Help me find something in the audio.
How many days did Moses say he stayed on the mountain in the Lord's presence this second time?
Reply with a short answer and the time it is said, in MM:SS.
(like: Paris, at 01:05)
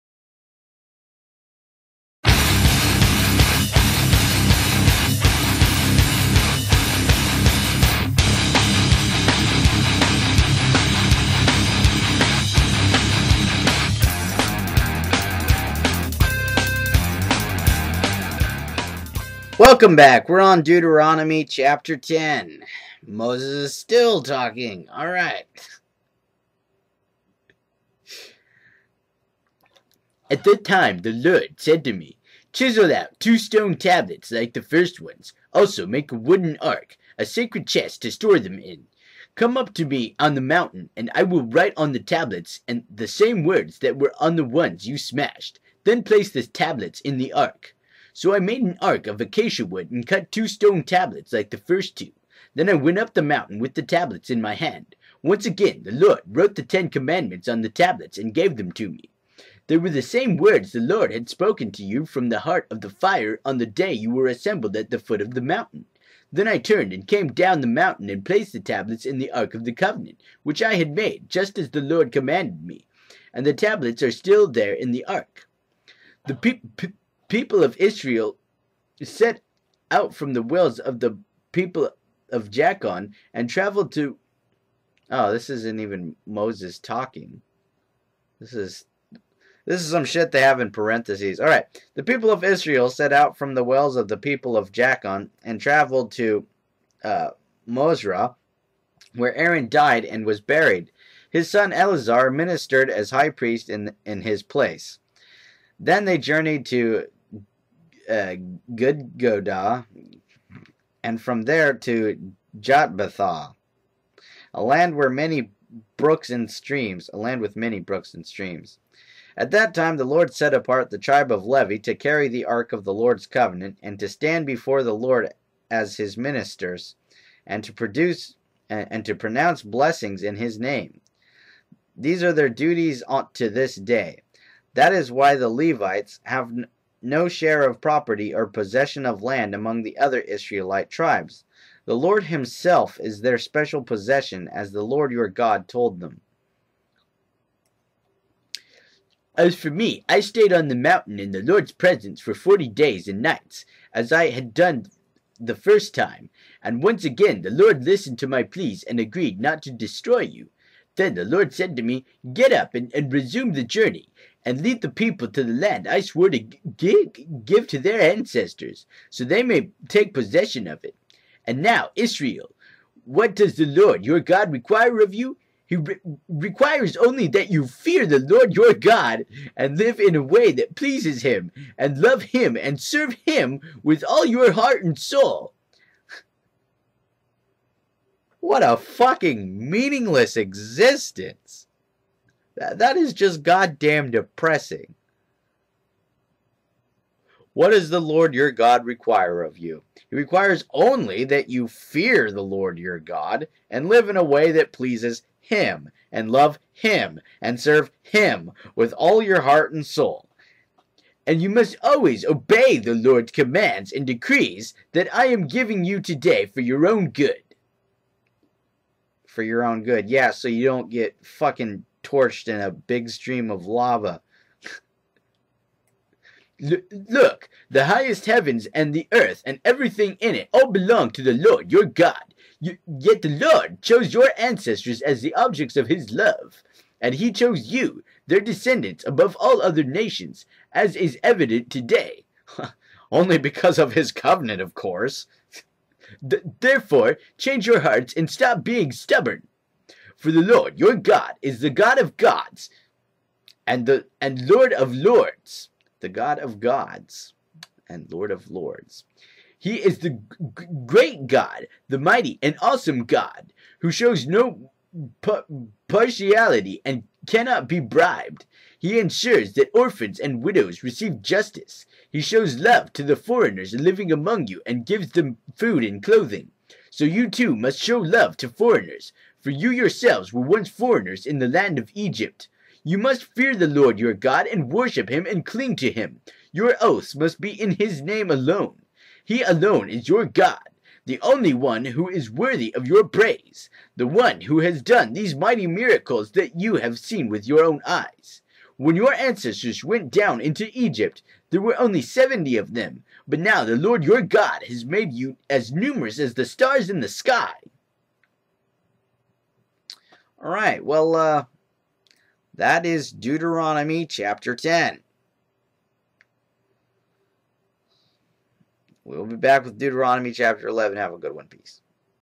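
40, at 02:32.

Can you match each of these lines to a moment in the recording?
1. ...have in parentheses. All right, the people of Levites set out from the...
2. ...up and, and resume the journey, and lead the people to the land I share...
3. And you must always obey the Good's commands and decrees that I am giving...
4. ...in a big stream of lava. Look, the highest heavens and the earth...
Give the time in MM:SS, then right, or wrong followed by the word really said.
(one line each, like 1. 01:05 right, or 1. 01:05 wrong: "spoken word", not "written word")
1. 01:30 wrong: "Israel", not "Levites"
2. 02:42 wrong: "swore", not "share"
3. 03:31 wrong: "Lord", not "Good"
4. 03:42 right.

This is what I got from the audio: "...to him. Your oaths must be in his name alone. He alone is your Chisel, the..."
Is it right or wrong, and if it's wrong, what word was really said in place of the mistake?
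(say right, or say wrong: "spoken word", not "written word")
wrong: "God", not "Chisel".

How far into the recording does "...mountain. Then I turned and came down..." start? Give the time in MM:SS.
01:05.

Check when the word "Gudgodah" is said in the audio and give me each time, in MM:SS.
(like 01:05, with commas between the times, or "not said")
01:48.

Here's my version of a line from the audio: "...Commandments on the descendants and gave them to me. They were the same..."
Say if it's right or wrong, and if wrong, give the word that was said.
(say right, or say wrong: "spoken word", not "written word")
wrong: "tablets", not "descendants".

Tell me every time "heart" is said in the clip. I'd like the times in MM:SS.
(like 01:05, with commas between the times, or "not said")
01:02, 03:04, 03:29, 04:07.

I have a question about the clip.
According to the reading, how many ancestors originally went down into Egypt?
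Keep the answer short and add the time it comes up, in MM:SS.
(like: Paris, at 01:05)
70, at 05:02.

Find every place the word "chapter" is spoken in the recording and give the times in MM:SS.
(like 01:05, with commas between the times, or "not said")
00:21, 05:14, 05:20.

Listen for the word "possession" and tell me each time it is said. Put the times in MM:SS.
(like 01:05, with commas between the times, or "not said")
02:18, 02:23, 02:50.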